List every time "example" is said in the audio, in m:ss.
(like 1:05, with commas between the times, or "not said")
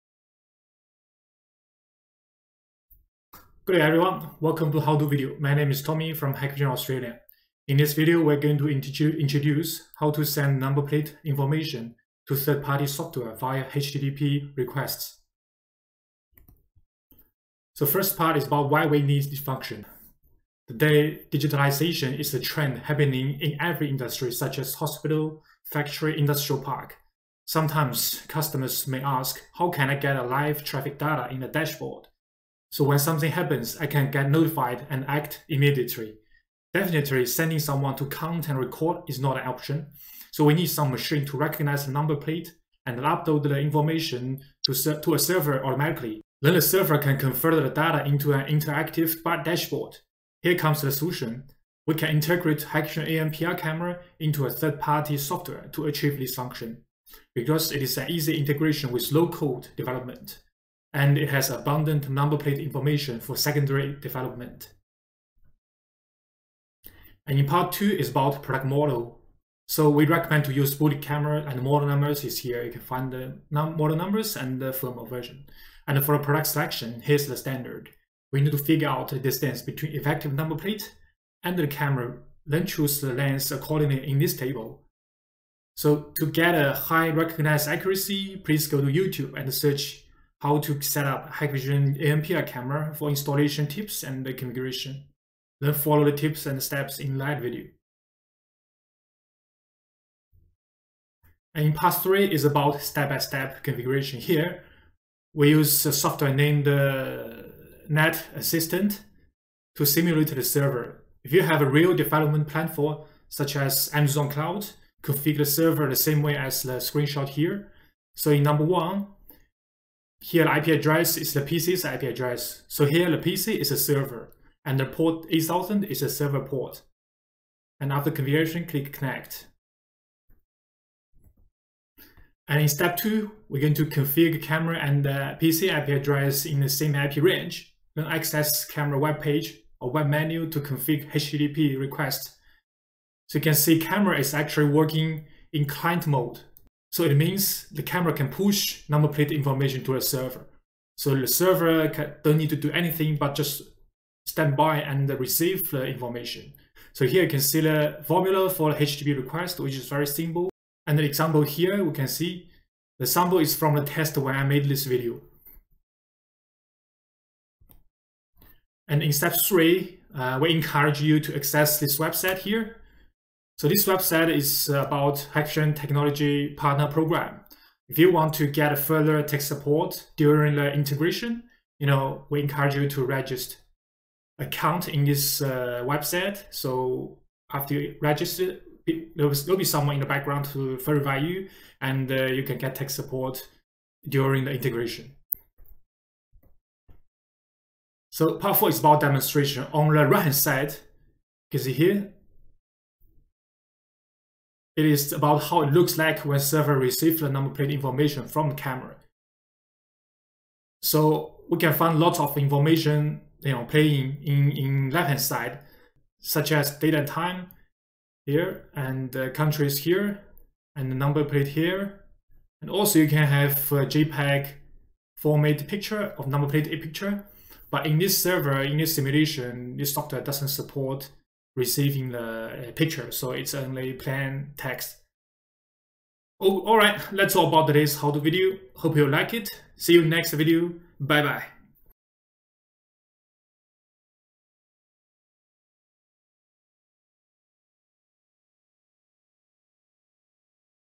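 2:41.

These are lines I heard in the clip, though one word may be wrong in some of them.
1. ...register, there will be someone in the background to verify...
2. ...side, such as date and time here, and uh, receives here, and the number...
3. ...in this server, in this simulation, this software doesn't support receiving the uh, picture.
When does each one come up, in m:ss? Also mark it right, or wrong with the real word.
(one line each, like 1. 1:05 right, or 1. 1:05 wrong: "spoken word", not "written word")
1. 3:08 right
2. 3:35 wrong: "countries", not "receives"
3. 3:47 right.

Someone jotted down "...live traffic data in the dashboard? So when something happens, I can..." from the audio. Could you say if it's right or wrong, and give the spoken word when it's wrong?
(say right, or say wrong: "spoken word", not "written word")
right.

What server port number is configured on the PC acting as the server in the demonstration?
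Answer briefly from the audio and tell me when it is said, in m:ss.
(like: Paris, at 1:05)
8000, at 2:05.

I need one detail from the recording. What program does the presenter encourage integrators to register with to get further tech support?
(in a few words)
Hikvision Technology Partner Program.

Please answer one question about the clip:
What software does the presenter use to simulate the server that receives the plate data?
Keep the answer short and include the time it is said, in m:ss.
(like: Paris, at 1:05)
Net Assistant, at 1:47.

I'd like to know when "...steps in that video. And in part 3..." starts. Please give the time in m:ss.
1:36.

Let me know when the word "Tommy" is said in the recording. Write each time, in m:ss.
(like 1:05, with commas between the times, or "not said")
0:05.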